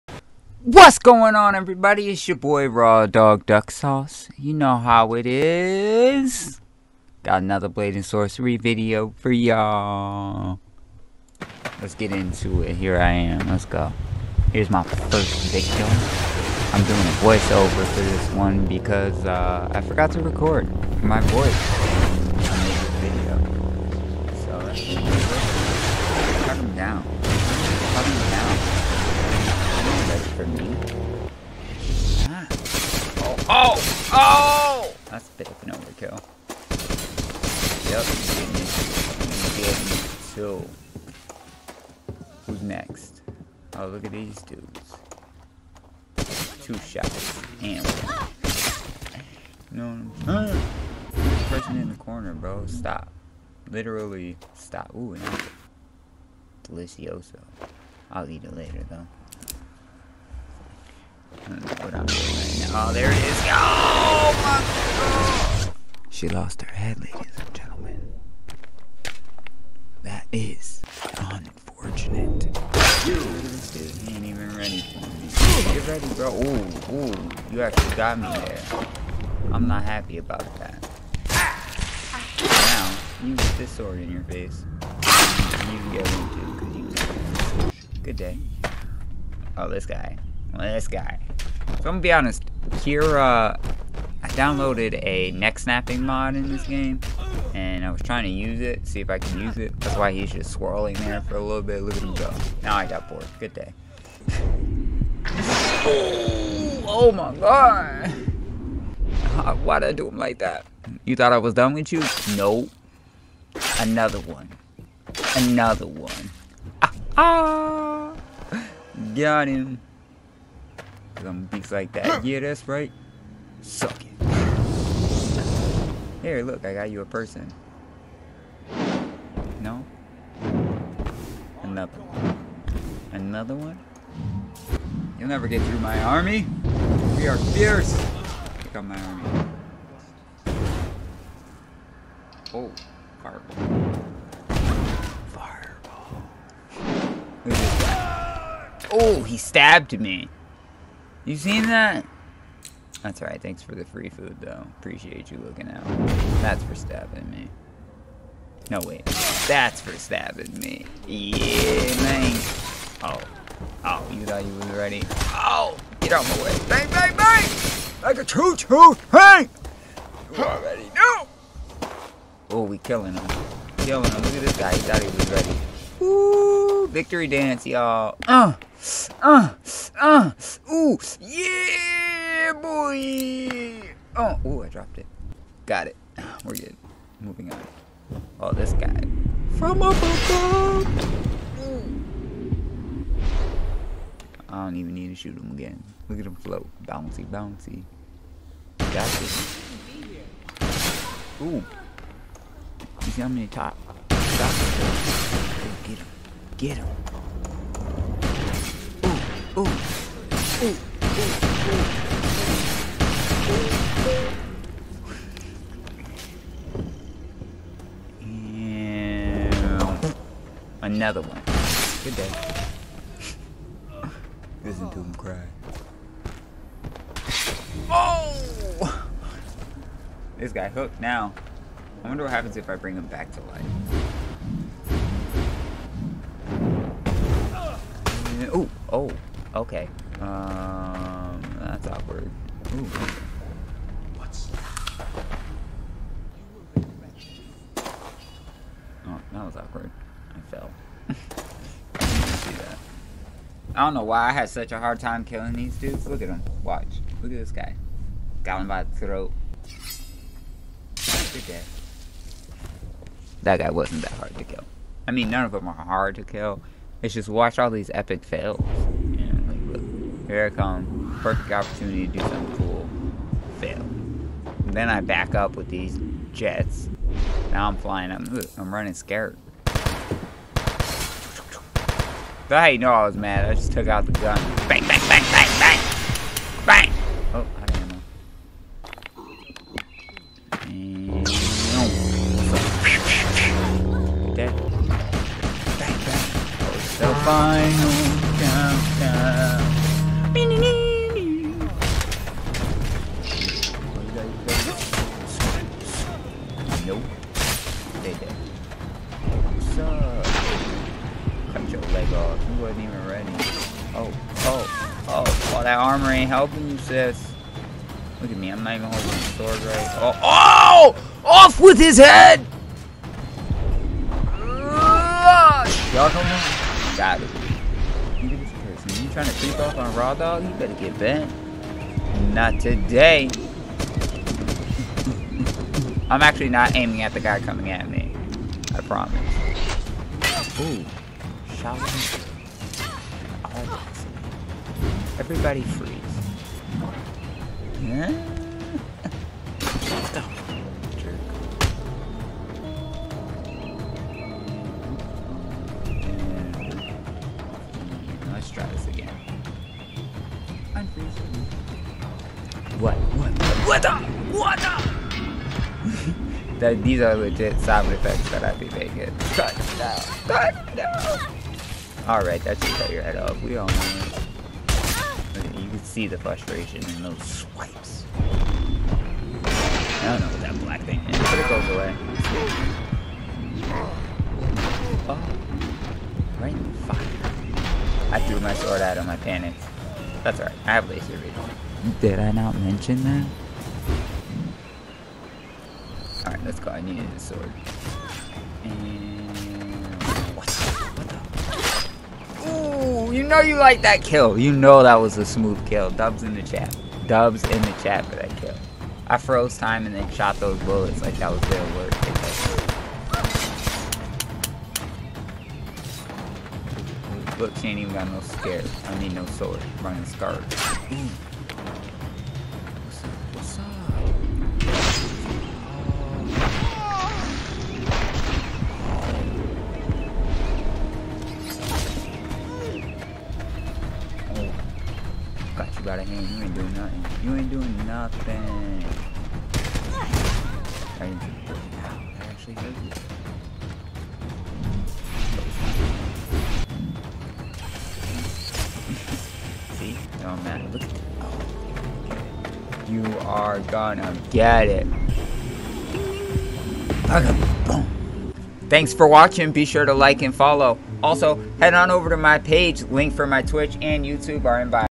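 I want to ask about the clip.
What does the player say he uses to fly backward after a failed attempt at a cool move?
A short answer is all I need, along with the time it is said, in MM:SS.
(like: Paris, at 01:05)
jets, at 04:35.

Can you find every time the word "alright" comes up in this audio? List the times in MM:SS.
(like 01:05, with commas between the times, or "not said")
02:33, 06:12, 06:30, 06:36.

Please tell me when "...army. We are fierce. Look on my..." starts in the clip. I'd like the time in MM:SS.
02:16.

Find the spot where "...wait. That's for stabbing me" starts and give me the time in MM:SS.
02:38.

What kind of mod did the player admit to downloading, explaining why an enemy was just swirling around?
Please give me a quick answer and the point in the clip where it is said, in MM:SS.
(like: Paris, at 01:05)
neck snapping mod, at 01:35.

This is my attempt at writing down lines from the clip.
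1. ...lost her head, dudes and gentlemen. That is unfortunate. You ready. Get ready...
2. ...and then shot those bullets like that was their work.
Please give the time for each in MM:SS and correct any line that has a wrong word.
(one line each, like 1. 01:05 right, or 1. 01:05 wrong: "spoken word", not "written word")
1. 01:06 wrong: "ladies", not "dudes"
2. 06:49 right.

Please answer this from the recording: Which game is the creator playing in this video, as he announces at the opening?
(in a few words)
Blade and Sorcery.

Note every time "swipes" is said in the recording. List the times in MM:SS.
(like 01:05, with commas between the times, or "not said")
06:17.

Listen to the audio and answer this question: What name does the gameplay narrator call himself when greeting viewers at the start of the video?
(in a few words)
Raw Dog Duck Sauce.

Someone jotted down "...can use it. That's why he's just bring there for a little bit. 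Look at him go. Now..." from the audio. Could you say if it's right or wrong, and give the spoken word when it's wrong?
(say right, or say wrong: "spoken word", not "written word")
wrong: "swirling", not "bring".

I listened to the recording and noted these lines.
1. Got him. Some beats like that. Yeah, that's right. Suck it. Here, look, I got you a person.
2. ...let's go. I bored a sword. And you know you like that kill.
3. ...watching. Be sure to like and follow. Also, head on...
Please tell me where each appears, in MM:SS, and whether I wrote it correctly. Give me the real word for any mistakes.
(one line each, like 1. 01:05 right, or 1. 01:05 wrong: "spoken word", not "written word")
1. 01:59 right
2. 06:36 wrong: "needed", not "bored"
3. 07:39 right.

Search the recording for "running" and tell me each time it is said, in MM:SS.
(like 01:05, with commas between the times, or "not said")
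04:38, 06:59.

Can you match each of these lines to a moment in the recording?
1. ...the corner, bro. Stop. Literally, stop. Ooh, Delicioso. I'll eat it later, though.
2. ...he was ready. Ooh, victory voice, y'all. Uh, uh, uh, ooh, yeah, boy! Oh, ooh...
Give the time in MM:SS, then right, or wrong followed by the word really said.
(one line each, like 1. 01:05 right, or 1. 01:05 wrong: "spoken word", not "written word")
1. 00:51 right
2. 02:55 wrong: "dance", not "voice".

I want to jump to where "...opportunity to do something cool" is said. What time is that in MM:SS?
04:31.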